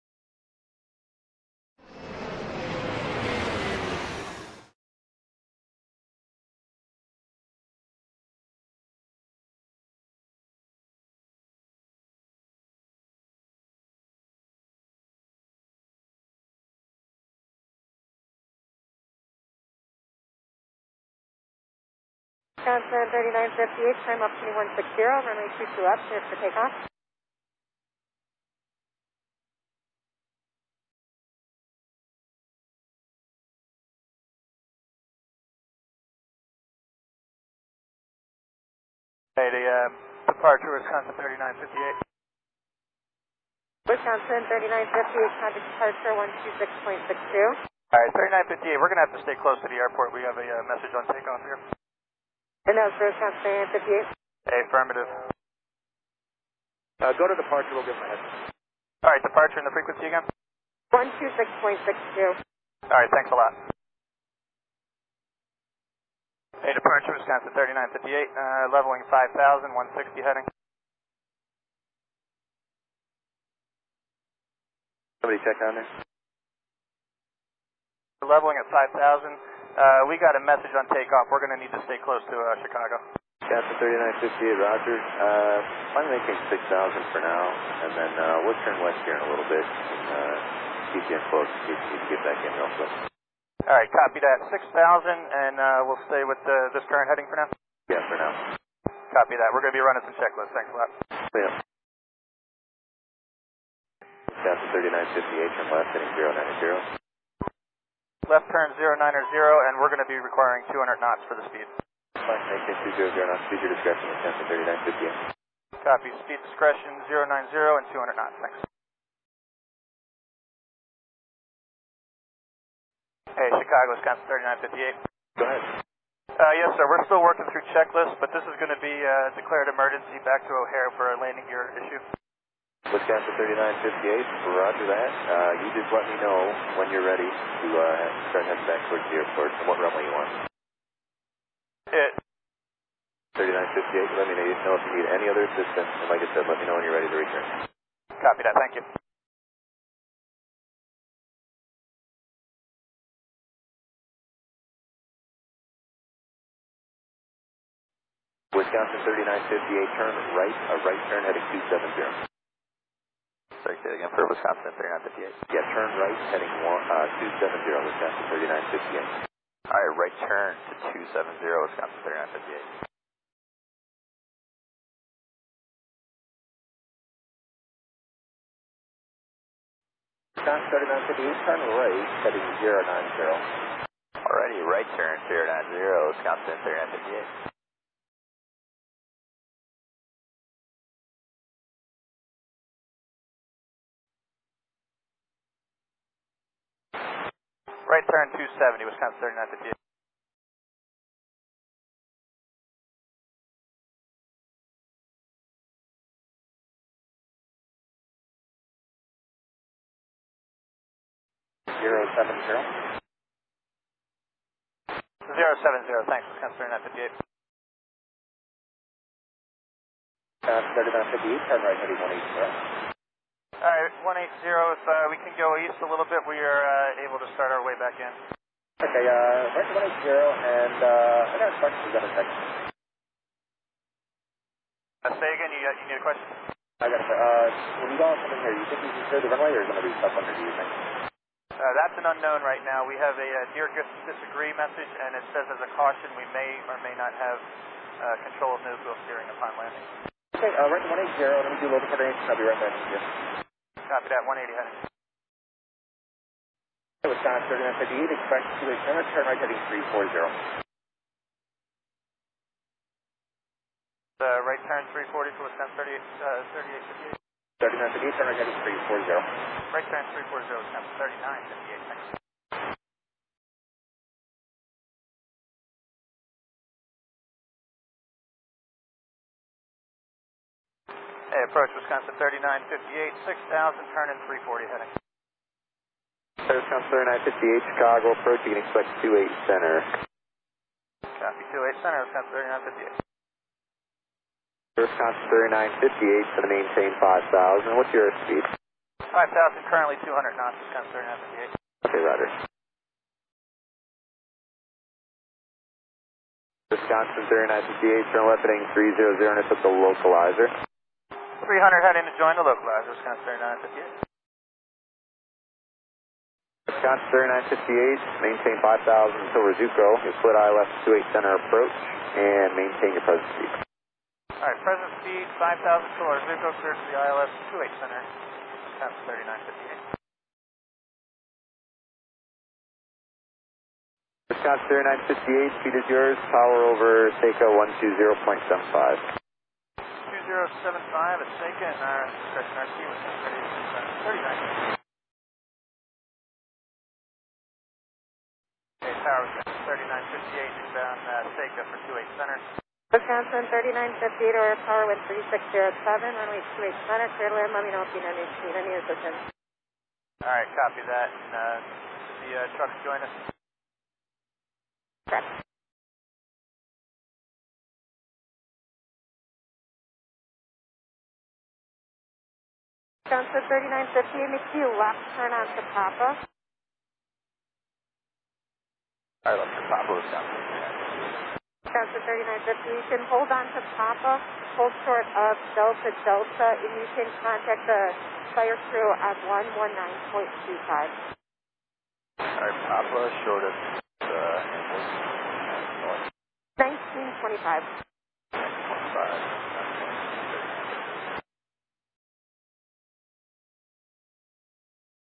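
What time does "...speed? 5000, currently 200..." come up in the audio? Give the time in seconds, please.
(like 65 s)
298 s.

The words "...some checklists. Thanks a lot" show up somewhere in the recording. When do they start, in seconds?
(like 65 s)
100 s.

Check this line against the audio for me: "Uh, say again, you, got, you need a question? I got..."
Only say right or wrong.
right.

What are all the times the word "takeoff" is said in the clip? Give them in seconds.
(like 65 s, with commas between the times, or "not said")
26 s, 51 s, 80 s.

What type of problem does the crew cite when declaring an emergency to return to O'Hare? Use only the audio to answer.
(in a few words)
landing gear issue.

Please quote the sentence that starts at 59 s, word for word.
All right, departure and the frequency again?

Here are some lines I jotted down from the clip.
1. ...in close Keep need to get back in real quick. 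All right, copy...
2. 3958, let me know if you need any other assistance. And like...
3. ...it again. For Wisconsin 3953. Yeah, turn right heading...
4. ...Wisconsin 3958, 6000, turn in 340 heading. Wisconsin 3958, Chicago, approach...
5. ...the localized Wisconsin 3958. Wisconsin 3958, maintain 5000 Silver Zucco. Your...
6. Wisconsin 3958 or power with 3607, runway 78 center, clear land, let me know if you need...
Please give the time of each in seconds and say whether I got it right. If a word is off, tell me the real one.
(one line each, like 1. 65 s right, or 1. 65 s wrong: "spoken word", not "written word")
1. 91 s right
2. 143 s right
3. 163 s wrong: "3958", not "3953"
4. 281 s right
5. 312 s right
6. 352 s wrong: "28", not "78".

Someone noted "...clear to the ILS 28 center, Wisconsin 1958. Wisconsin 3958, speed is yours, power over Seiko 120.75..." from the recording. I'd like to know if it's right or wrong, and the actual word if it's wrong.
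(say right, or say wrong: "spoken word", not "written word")
wrong: "3958", not "1958".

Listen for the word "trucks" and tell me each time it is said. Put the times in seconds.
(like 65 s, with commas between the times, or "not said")
362 s.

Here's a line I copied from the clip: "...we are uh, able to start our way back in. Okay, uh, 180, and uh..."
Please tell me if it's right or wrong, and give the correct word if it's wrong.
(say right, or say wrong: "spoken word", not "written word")
right.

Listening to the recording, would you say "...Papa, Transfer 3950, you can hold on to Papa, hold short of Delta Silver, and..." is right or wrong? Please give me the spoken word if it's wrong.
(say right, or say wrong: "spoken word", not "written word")
wrong: "Delta", not "Silver".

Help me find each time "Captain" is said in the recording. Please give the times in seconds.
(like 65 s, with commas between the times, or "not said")
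83 s, 104 s.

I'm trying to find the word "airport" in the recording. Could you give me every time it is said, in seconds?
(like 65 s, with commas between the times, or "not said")
49 s, 139 s.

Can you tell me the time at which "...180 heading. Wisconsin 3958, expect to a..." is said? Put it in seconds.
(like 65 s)
254 s.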